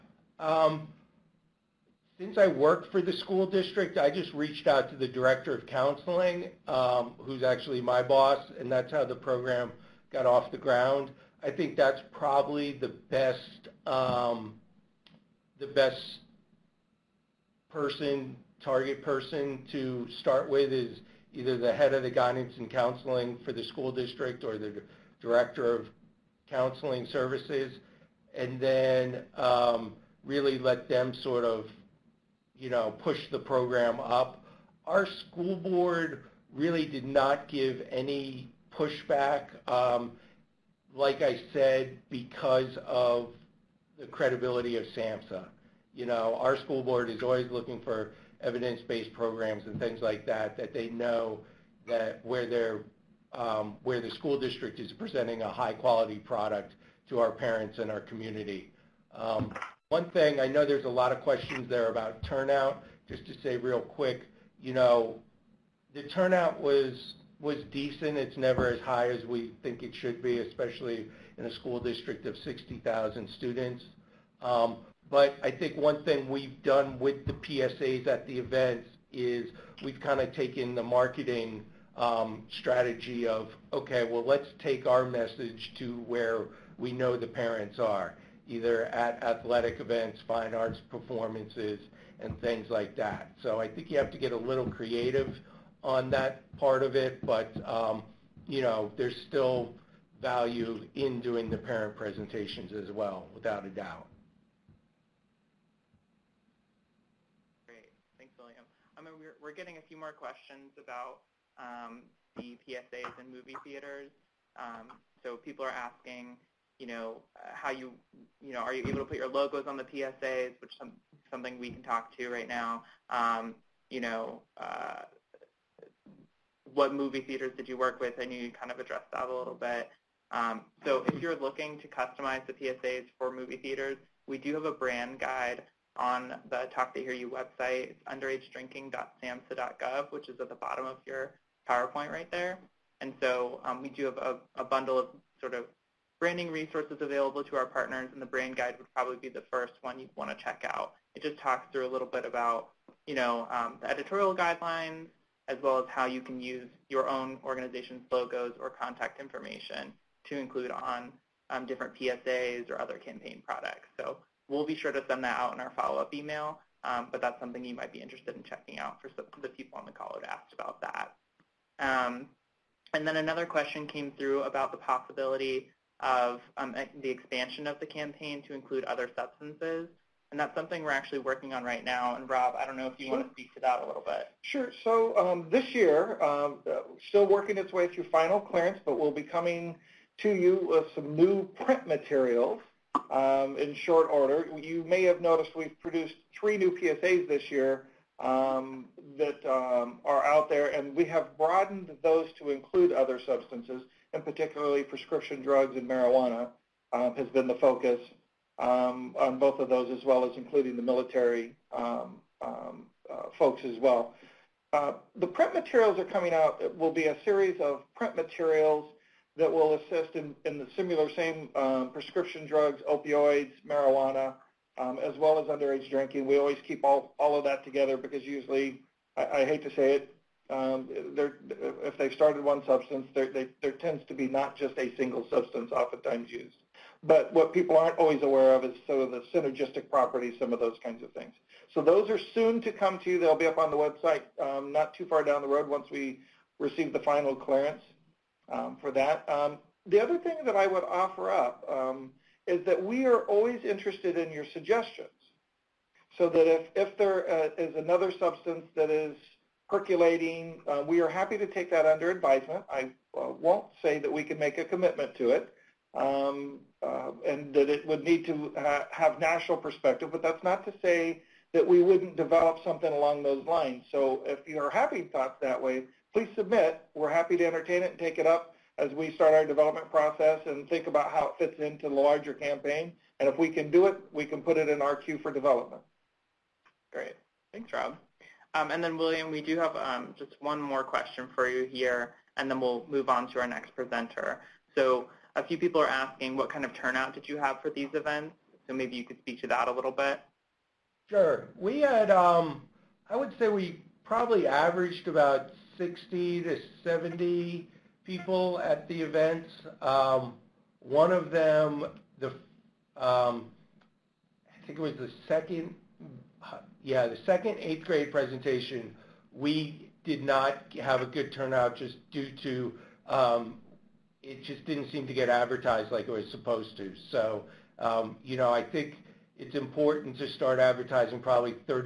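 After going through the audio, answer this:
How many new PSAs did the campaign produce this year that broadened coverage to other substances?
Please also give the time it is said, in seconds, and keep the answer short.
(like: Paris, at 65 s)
3, at 196 s.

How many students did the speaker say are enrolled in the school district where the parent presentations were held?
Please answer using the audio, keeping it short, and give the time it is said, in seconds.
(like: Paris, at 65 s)
60,000, at 72 s.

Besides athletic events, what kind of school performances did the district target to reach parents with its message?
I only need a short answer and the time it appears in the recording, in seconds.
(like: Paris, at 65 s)
fine arts, at 90 s.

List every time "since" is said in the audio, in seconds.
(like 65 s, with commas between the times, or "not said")
2 s.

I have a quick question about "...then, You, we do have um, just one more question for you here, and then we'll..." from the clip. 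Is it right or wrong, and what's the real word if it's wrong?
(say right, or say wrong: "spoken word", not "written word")
wrong: "William", not "You".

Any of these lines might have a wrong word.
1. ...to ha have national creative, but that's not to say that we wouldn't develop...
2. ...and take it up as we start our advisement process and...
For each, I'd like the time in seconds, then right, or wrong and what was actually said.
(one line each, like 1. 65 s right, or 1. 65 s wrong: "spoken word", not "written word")
1. 268 s wrong: "perspective", not "creative"
2. 277 s wrong: "development", not "advisement".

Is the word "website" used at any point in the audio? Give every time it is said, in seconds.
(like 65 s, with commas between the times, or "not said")
137 s, 243 s.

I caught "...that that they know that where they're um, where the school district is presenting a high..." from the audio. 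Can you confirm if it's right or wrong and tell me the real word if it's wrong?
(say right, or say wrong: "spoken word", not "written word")
right.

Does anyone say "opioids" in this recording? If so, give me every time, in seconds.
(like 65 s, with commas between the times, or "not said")
222 s.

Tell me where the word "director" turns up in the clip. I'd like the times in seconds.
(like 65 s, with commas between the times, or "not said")
5 s, 25 s.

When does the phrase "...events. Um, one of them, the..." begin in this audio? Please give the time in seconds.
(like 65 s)
309 s.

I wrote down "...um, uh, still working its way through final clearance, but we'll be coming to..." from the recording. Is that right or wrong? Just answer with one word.
right.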